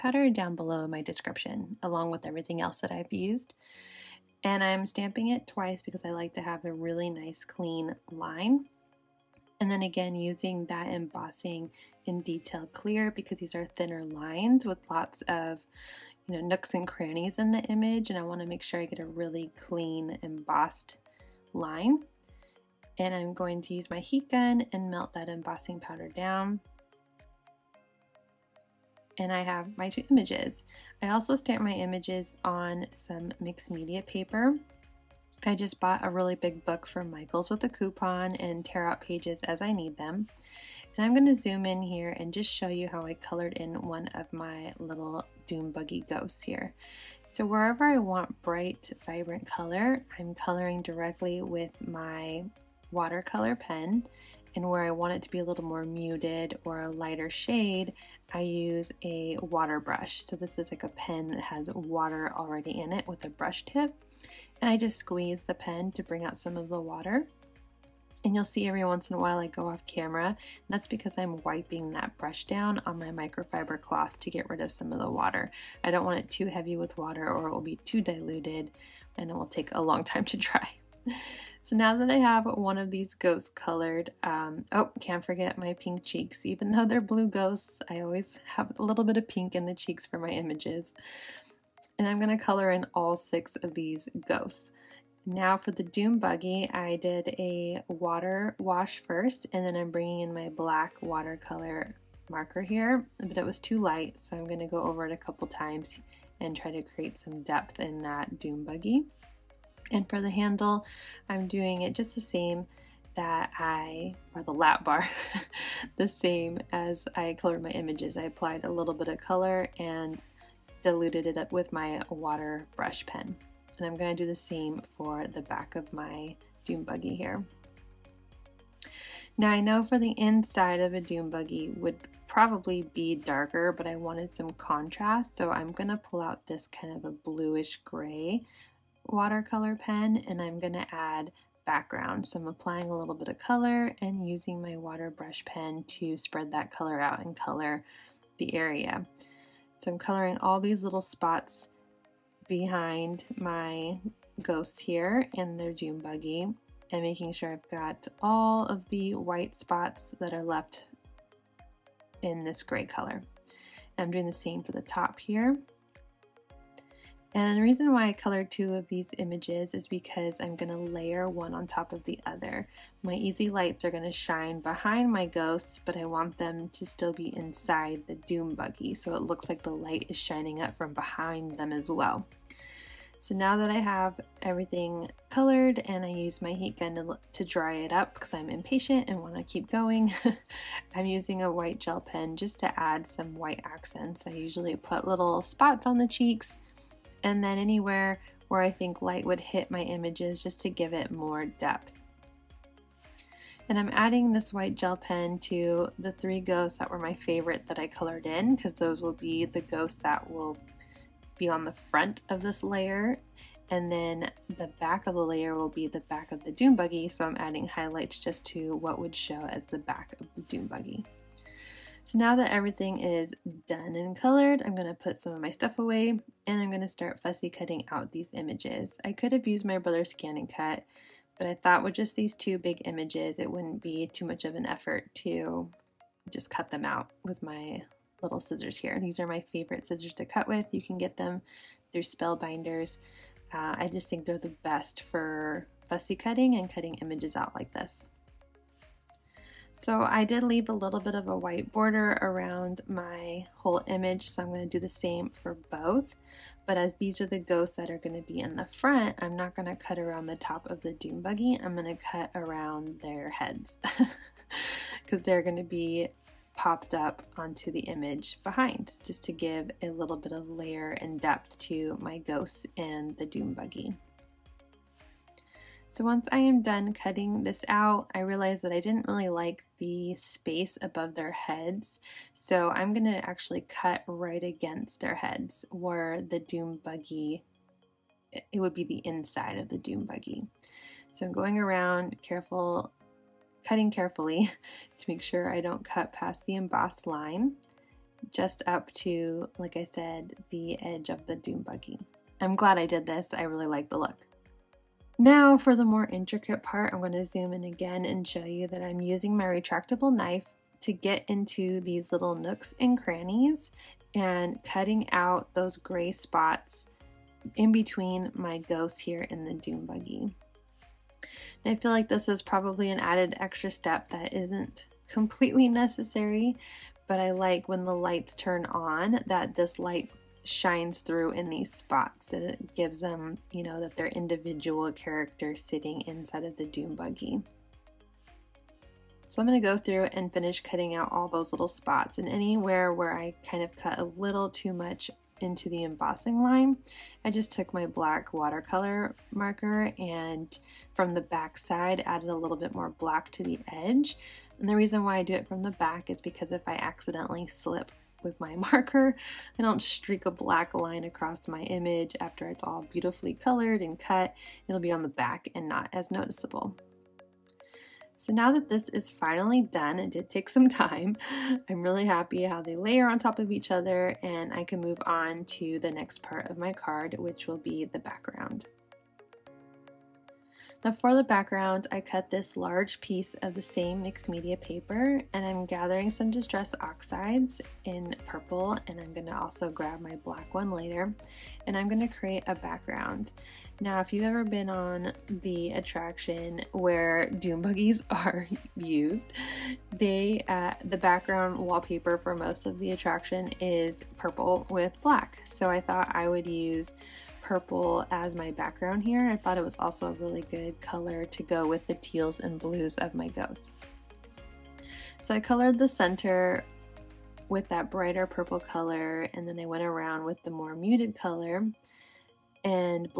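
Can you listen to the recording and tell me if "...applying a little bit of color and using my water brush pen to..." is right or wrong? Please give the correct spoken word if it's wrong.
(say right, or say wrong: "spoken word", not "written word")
right.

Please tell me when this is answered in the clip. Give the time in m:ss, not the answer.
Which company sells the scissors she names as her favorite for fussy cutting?
4:02.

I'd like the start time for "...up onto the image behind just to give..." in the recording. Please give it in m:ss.
4:26.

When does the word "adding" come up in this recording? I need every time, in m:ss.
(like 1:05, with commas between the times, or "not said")
3:23, 3:37.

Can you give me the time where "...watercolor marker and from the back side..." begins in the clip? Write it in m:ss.
5:48.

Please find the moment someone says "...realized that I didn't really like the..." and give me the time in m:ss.
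4:38.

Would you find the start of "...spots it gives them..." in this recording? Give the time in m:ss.
5:31.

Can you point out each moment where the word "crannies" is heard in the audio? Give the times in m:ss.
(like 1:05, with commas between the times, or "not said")
0:16, 5:12.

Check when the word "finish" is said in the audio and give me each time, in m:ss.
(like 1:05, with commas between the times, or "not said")
5:40.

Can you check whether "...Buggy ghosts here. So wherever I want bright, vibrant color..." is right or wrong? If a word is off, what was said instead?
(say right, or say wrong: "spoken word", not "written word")
right.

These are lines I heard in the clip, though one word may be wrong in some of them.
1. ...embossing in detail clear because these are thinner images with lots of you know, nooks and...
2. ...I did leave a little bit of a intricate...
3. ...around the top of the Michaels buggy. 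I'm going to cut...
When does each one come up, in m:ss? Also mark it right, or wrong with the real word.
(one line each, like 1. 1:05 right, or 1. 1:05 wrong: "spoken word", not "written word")
1. 0:10 wrong: "lines", not "images"
2. 4:10 wrong: "white", not "intricate"
3. 4:19 wrong: "Doom", not "Michaels".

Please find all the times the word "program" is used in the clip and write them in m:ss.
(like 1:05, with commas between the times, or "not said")
not said.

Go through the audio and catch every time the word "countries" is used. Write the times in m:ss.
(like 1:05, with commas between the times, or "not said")
not said.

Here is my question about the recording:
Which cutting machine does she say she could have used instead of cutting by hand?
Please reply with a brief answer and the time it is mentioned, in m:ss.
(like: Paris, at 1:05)
ScanNCut, at 3:50.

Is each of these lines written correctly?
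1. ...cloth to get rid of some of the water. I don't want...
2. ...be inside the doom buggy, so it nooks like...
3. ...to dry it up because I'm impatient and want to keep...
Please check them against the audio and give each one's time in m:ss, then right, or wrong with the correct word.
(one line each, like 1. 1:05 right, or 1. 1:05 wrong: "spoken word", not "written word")
1. 1:13 right
2. 2:57 wrong: "looks", not "nooks"
3. 3:07 right.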